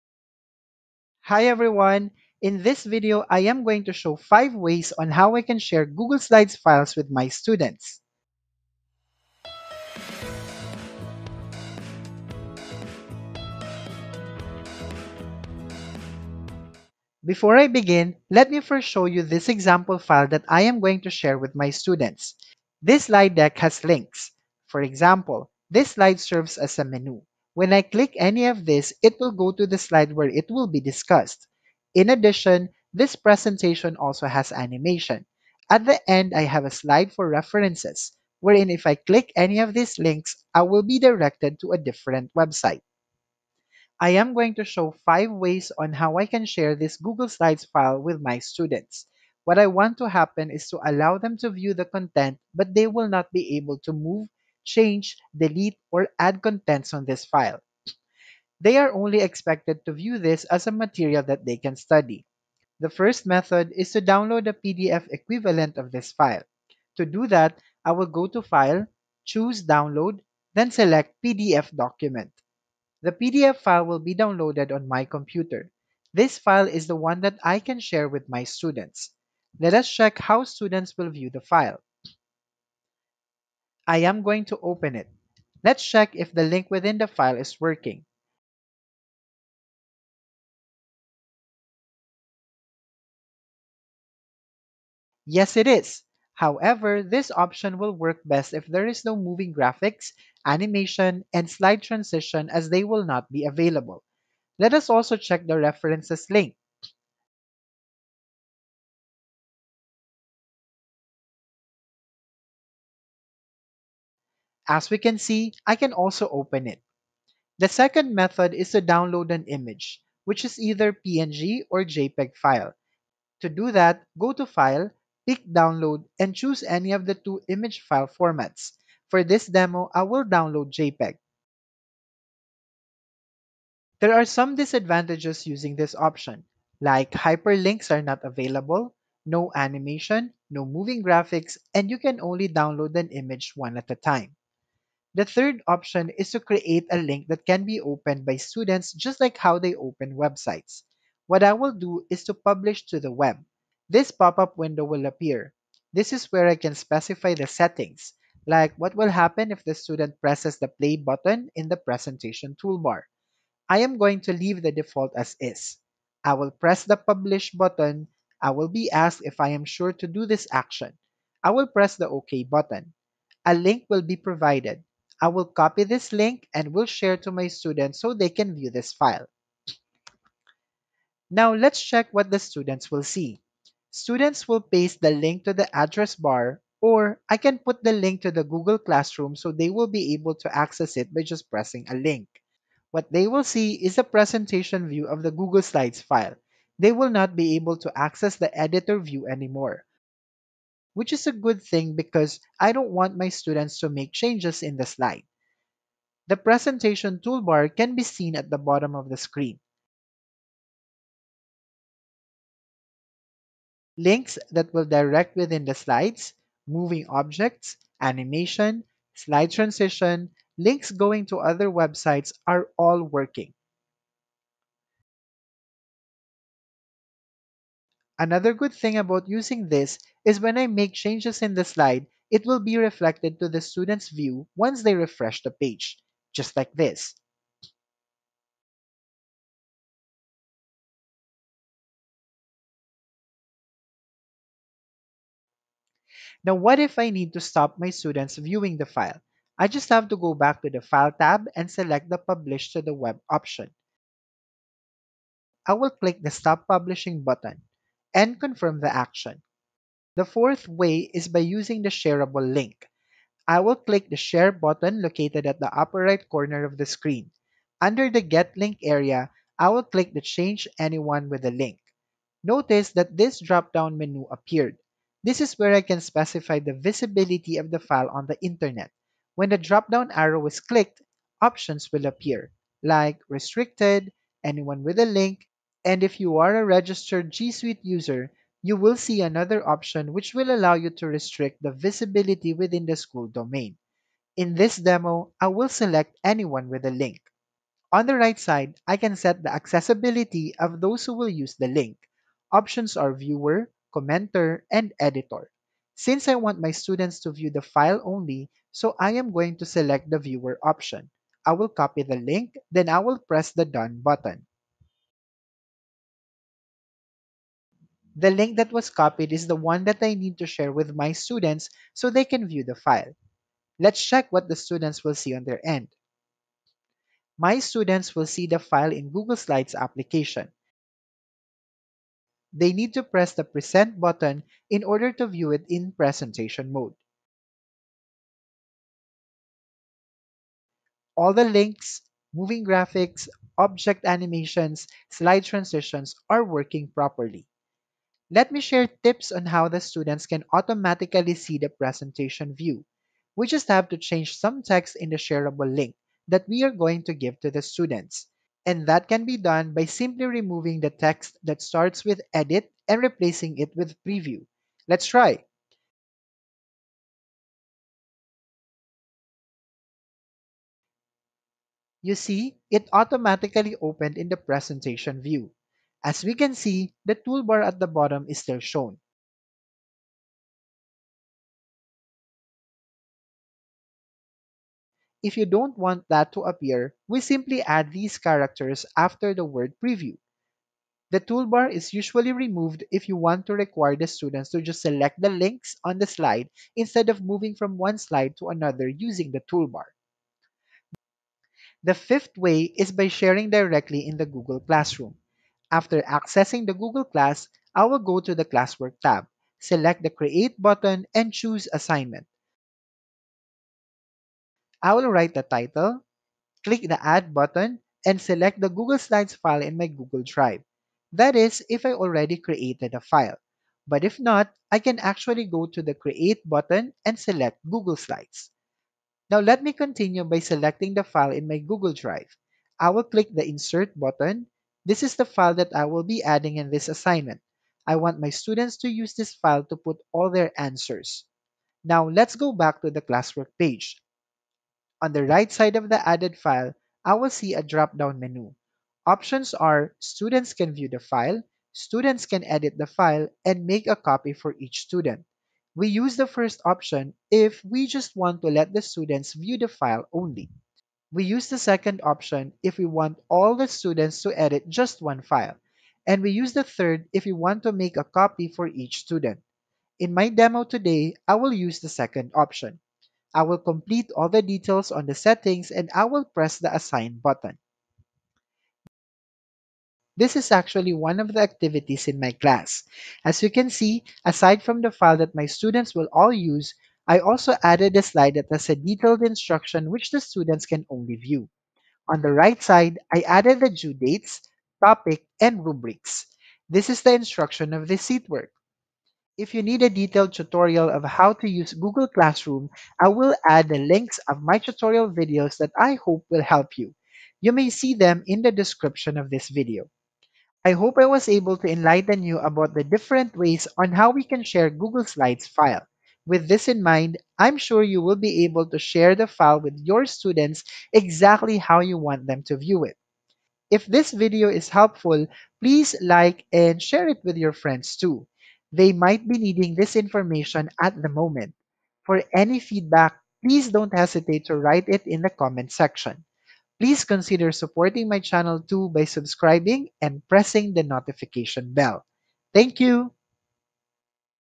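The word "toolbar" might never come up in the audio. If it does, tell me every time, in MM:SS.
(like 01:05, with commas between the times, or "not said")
02:42, 03:27, 06:17, 06:31, 06:39.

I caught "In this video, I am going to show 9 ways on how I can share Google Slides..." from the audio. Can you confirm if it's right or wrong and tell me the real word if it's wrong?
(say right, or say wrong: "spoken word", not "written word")
wrong: "5", not "9".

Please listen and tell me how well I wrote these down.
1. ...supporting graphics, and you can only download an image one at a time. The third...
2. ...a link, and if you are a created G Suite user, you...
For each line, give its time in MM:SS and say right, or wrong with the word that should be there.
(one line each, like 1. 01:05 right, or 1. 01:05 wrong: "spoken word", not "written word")
1. 02:20 wrong: "moving", not "supporting"
2. 04:44 wrong: "registered", not "created".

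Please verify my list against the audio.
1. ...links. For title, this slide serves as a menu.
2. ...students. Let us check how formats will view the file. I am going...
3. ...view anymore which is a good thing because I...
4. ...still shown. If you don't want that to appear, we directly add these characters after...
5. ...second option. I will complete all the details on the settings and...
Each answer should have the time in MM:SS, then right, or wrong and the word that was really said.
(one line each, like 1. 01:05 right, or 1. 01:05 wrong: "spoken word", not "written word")
1. 00:23 wrong: "example", not "title"
2. 01:18 wrong: "students", not "formats"
3. 03:18 right
4. 06:18 wrong: "simply", not "directly"
5. 07:51 right.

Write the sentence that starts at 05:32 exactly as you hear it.
They need to press the Present button in order to view it in presentation mode.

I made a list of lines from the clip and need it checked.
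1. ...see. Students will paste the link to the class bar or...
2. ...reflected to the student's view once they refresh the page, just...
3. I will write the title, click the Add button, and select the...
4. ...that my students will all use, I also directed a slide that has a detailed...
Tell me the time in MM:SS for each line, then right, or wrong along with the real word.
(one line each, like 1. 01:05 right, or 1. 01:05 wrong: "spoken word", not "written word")
1. 03:03 wrong: "address", not "class"
2. 03:52 right
3. 06:54 right
4. 08:05 wrong: "added", not "directed".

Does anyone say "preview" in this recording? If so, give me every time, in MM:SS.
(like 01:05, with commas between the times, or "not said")
06:04, 06:29.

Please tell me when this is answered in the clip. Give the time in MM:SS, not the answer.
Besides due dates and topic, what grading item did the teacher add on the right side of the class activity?
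08:15.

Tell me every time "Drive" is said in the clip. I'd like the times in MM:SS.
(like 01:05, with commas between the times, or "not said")
07:00, 07:11.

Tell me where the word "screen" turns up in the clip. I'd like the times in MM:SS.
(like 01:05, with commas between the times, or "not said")
03:29, 04:26.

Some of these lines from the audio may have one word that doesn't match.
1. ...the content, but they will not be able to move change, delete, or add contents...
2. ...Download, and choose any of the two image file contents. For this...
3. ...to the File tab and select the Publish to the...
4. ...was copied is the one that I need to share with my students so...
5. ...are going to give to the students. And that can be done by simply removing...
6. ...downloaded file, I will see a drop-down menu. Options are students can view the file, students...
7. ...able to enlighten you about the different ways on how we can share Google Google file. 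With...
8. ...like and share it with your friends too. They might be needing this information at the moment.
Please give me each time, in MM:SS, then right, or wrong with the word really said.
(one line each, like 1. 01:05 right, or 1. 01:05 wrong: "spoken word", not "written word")
1. 00:51 right
2. 02:05 wrong: "formats", not "contents"
3. 04:10 right
4. 05:18 right
5. 05:56 right
6. 07:26 wrong: "added", not "downloaded"
7. 08:31 wrong: "Slides", not "Google"
8. 08:46 right.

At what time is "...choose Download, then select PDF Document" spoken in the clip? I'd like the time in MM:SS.
01:09.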